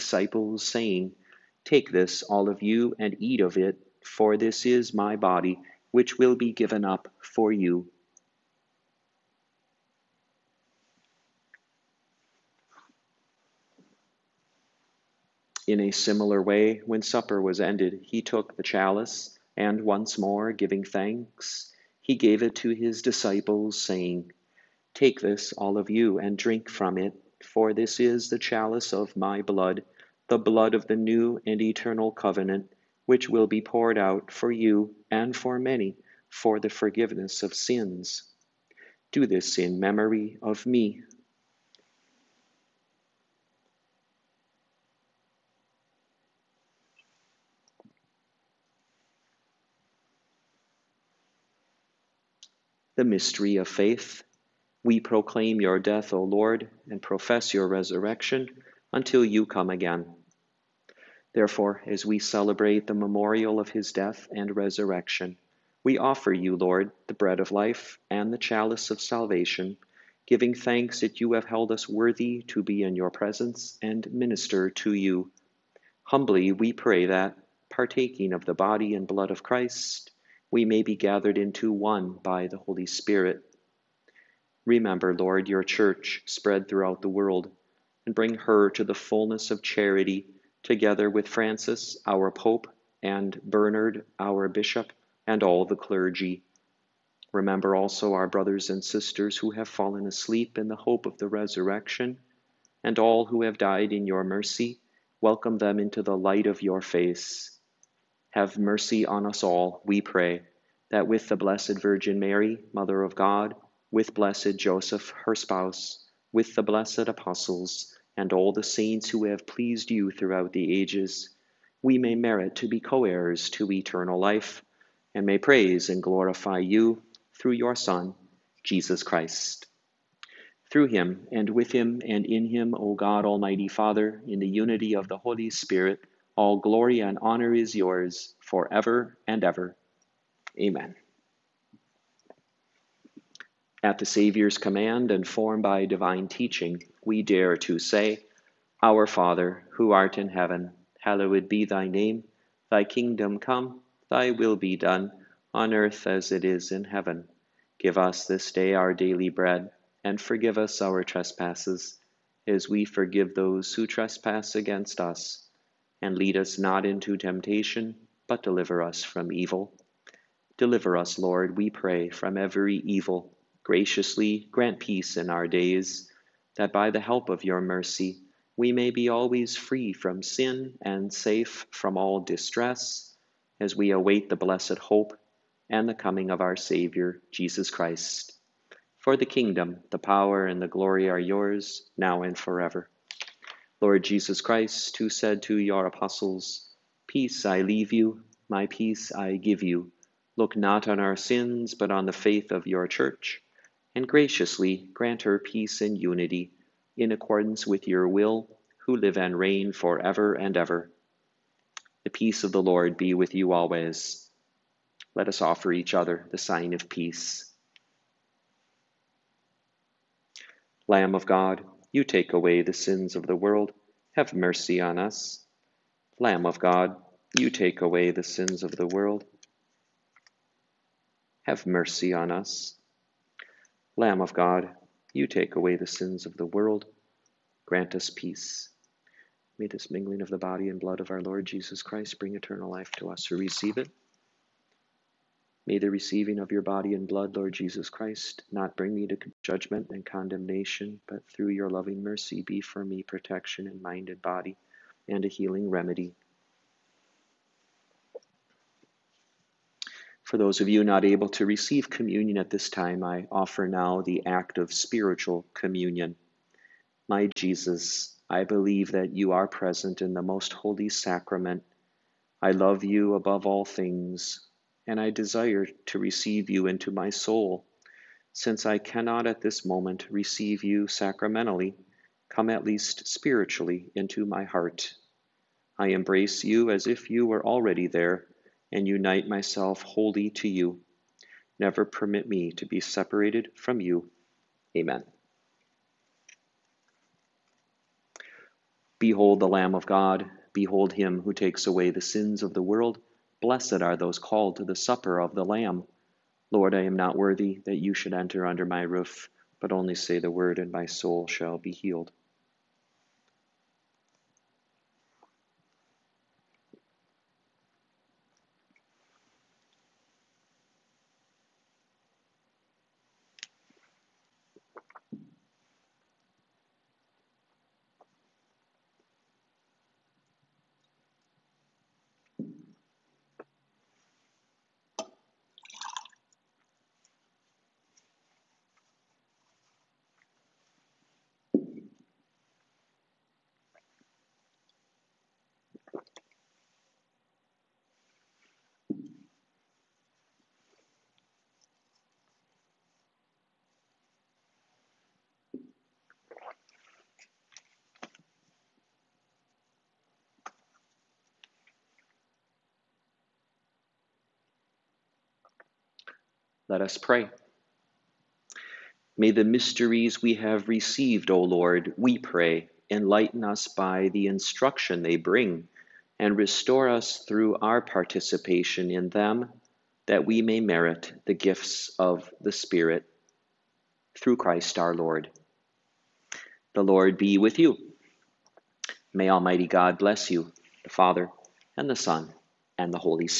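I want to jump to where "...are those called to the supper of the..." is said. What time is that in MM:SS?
05:03.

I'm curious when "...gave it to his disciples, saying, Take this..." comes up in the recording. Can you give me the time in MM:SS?
00:22.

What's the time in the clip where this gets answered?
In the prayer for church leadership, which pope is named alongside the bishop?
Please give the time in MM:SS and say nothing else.
01:31.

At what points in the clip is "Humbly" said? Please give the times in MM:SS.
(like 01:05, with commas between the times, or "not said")
01:16.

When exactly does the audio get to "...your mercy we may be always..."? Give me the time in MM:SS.
02:57.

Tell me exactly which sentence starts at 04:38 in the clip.
Since I cannot at this moment receive you sacramentally, come at least spiritually into my heart.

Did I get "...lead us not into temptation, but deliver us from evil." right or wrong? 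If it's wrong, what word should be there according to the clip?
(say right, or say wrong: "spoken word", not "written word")
right.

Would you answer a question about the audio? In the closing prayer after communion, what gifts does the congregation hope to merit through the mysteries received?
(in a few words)
Gifts of the Spirit.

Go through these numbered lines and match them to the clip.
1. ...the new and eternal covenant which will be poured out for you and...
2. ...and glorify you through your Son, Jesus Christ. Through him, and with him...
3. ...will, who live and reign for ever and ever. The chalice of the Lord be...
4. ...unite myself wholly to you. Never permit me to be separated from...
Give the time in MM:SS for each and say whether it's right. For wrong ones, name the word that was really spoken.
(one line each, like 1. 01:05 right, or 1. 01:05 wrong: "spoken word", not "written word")
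1. 00:30 right
2. 02:05 right
3. 03:28 wrong: "peace", not "chalice"
4. 04:48 right.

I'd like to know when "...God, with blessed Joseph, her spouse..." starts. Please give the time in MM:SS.
01:53.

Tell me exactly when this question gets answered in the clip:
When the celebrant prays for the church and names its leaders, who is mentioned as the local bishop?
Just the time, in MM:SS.
01:33.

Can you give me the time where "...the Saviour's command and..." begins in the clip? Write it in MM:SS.
02:23.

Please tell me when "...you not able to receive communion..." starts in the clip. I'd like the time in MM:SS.
04:20.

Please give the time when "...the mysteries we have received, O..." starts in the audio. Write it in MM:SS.
06:09.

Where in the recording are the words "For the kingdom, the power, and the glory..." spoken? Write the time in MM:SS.
03:08.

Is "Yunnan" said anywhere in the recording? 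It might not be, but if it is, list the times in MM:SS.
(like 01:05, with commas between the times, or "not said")
not said.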